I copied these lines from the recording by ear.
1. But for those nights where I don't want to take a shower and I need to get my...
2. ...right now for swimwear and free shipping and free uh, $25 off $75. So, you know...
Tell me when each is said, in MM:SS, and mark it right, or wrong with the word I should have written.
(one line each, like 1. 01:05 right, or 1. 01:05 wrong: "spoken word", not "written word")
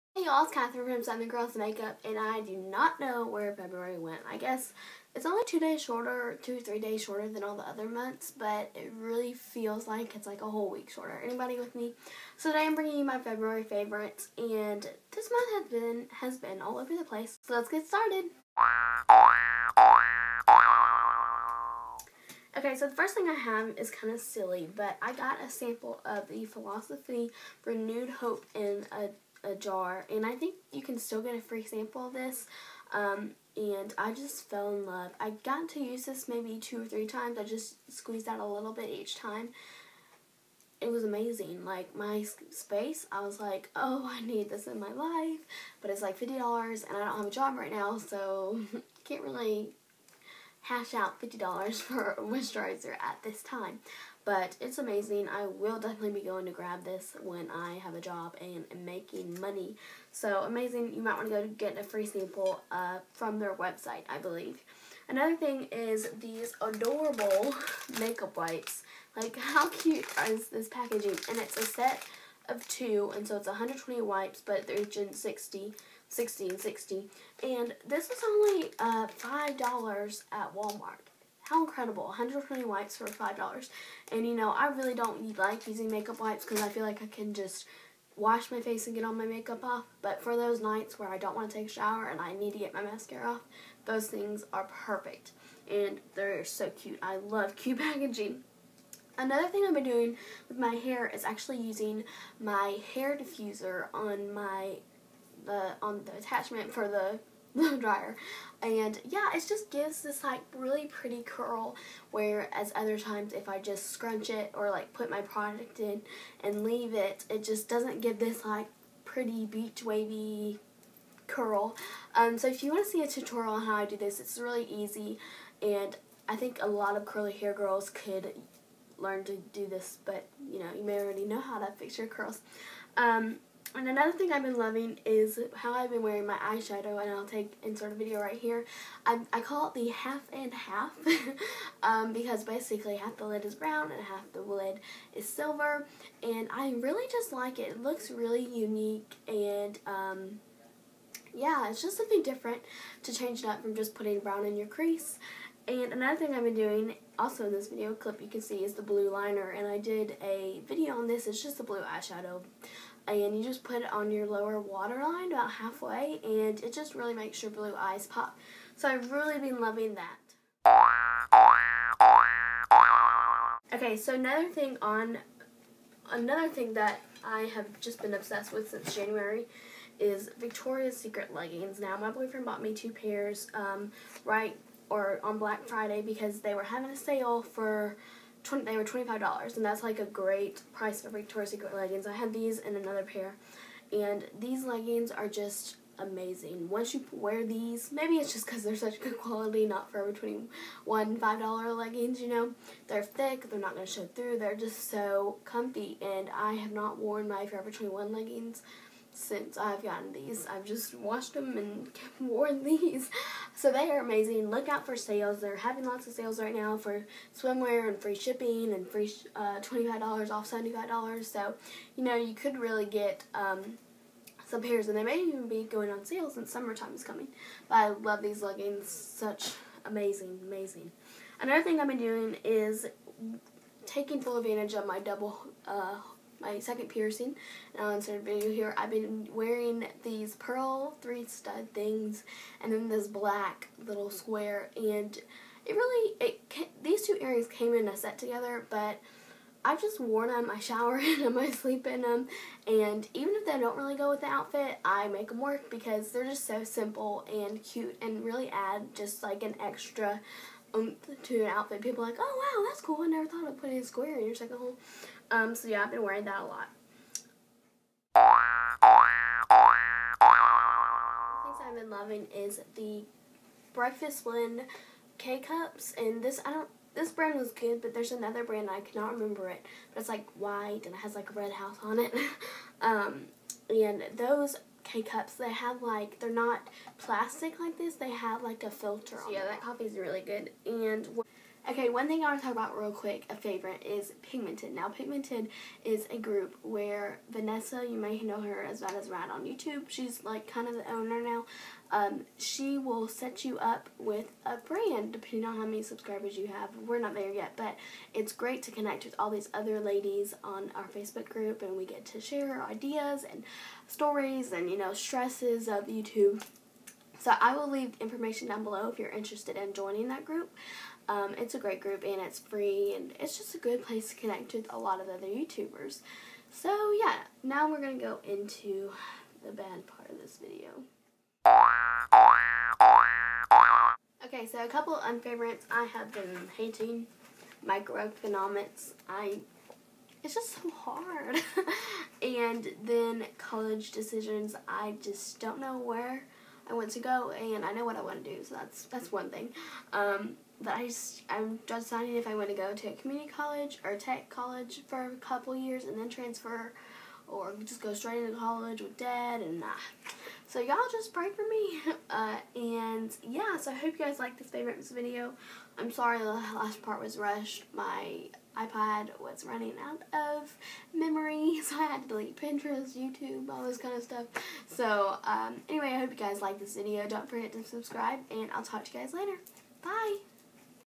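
1. 01:30 right
2. 03:36 right.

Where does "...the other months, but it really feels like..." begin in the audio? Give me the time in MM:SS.
00:07.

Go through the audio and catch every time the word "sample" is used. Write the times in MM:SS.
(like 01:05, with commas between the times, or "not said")
00:25, 00:31, 01:02.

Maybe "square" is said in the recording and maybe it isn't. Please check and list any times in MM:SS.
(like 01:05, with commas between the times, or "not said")
04:04, 04:23.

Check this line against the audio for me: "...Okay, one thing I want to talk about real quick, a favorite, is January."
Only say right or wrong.
wrong.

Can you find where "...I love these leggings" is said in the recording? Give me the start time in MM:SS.
03:47.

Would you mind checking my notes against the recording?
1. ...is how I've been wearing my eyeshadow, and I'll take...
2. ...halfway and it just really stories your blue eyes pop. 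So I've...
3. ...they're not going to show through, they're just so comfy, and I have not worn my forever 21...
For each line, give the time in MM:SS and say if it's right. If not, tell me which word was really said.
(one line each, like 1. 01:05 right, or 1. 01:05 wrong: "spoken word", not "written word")
1. 02:15 right
2. 02:45 wrong: "makes", not "stories"
3. 03:23 right.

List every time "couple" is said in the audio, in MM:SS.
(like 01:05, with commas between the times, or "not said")
05:34, 05:55.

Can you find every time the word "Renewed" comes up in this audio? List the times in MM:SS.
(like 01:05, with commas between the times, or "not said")
00:27.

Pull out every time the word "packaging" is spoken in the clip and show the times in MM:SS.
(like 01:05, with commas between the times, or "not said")
01:10, 01:37.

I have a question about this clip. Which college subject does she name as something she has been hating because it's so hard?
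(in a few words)
Microeconomics.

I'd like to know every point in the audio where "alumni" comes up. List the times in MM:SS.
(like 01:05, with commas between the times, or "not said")
not said.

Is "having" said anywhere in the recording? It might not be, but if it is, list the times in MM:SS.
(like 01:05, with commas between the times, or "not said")
03:06, 03:35.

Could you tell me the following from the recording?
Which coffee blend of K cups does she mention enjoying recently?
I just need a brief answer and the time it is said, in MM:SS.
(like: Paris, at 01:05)
Breakfast Blend, at 04:33.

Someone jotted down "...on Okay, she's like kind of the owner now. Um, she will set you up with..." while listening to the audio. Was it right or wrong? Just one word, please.
wrong.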